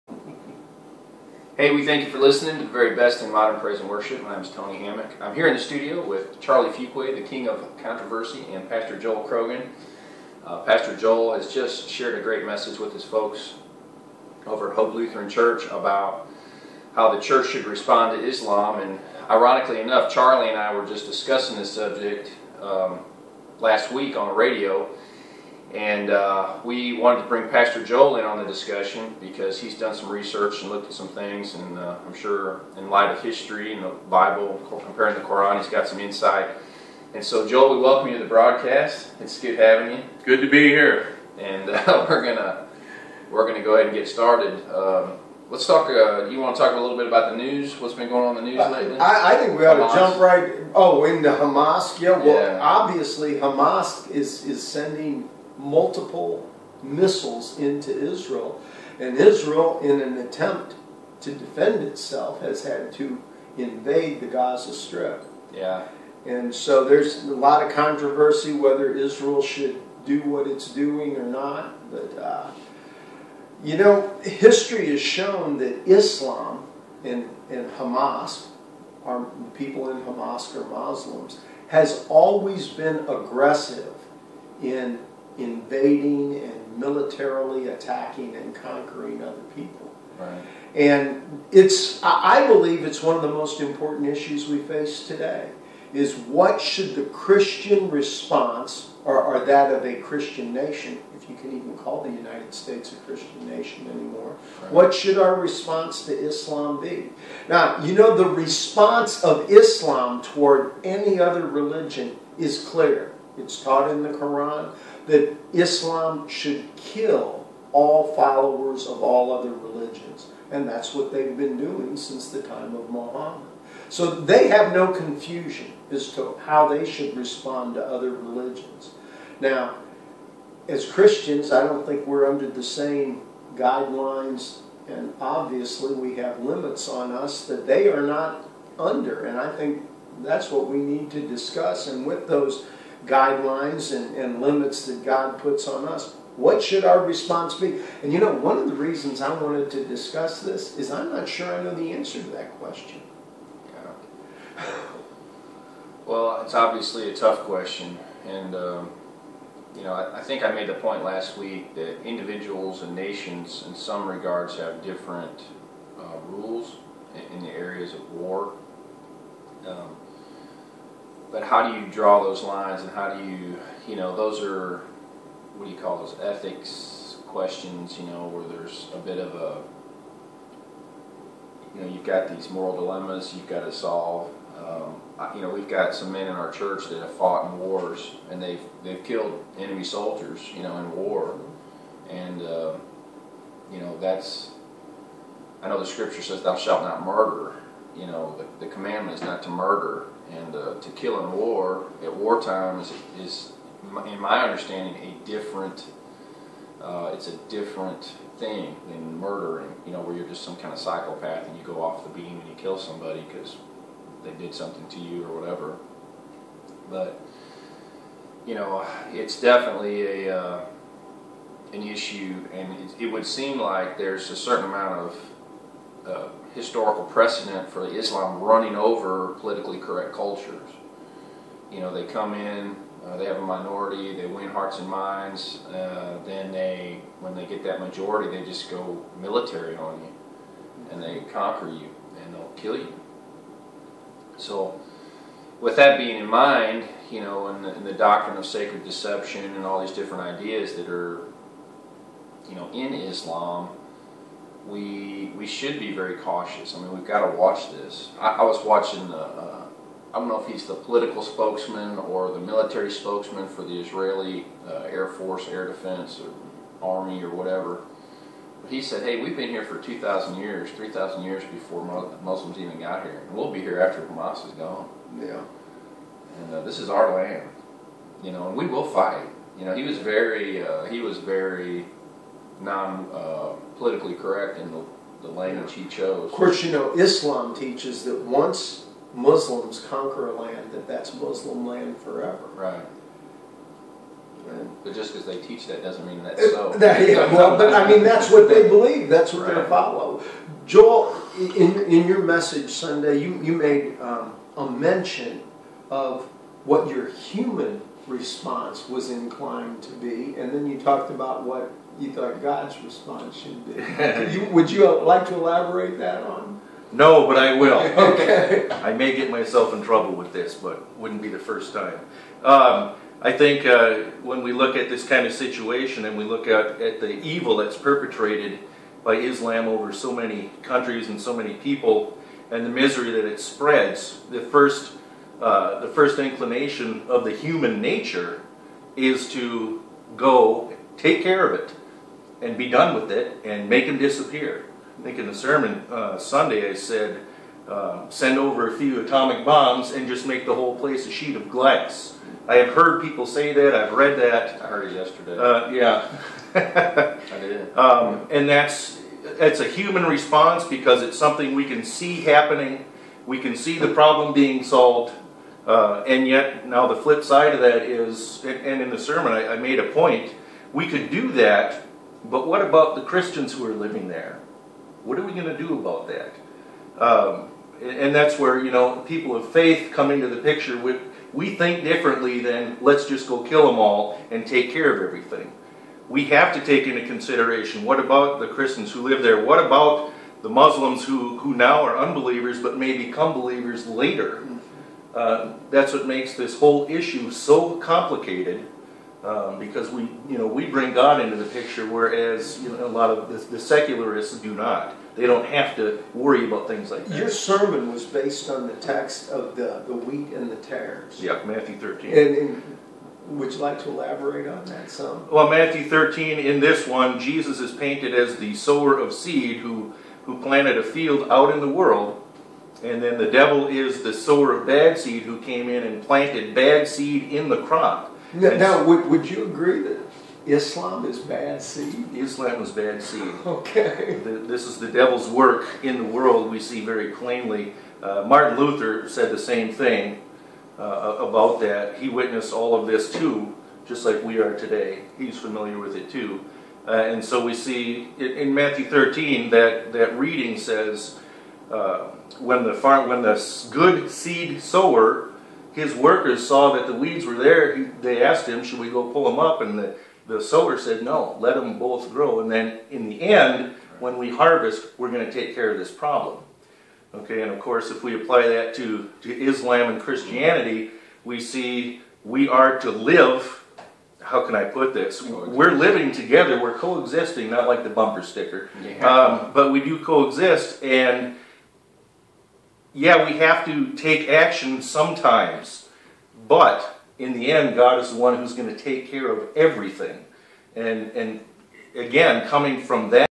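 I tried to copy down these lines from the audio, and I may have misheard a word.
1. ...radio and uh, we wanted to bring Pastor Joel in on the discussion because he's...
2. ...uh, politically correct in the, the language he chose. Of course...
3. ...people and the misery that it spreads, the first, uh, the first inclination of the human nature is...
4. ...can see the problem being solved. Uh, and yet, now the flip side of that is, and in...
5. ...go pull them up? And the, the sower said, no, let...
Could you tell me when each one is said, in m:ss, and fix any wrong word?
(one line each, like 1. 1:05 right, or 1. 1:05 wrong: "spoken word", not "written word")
1. 0:24 right
2. 4:43 right
3. 5:31 right
4. 6:03 right
5. 7:38 right.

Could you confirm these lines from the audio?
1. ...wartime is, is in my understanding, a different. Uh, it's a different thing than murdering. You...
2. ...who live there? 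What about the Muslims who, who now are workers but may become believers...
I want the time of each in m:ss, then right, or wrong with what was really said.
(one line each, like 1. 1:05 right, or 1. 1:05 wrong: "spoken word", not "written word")
1. 3:22 right
2. 6:28 wrong: "unbelievers", not "workers".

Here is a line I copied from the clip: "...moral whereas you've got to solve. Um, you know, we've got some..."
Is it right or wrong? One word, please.
wrong.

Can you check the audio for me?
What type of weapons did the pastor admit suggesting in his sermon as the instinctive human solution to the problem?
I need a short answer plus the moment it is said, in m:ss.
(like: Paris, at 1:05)
atomic bombs, at 5:49.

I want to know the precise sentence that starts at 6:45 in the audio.
They don't have to worry about things like that.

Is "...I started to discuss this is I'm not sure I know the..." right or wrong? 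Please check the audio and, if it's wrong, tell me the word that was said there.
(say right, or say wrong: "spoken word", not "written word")
wrong: "wanted", not "started".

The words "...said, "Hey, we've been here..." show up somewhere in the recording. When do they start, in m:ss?
4:28.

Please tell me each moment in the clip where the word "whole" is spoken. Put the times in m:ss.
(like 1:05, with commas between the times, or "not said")
5:50, 6:36.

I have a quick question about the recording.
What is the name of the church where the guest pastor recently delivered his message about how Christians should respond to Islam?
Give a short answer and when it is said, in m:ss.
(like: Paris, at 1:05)
Hope Lutheran Church, at 0:14.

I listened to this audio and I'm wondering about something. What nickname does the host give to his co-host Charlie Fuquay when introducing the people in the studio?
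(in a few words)
king of controversy.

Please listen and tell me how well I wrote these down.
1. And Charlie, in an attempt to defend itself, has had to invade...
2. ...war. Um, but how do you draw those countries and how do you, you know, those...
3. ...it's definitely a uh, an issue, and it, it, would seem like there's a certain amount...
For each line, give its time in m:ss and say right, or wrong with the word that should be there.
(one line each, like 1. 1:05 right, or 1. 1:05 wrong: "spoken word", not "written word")
1. 0:58 wrong: "Israel", not "Charlie"
2. 2:48 wrong: "lines", not "countries"
3. 3:39 right.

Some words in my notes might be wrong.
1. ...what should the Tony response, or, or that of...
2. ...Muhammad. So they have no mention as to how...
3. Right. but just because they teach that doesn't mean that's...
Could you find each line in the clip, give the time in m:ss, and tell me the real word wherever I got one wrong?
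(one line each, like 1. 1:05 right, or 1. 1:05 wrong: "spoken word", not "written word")
1. 1:36 wrong: "Christian", not "Tony"
2. 2:02 wrong: "confusion", not "mention"
3. 4:52 right.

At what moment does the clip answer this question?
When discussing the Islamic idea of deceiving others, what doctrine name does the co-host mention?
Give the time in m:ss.
4:08.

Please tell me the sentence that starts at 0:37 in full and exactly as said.
And so, Joel, we welcome you to the broadcast.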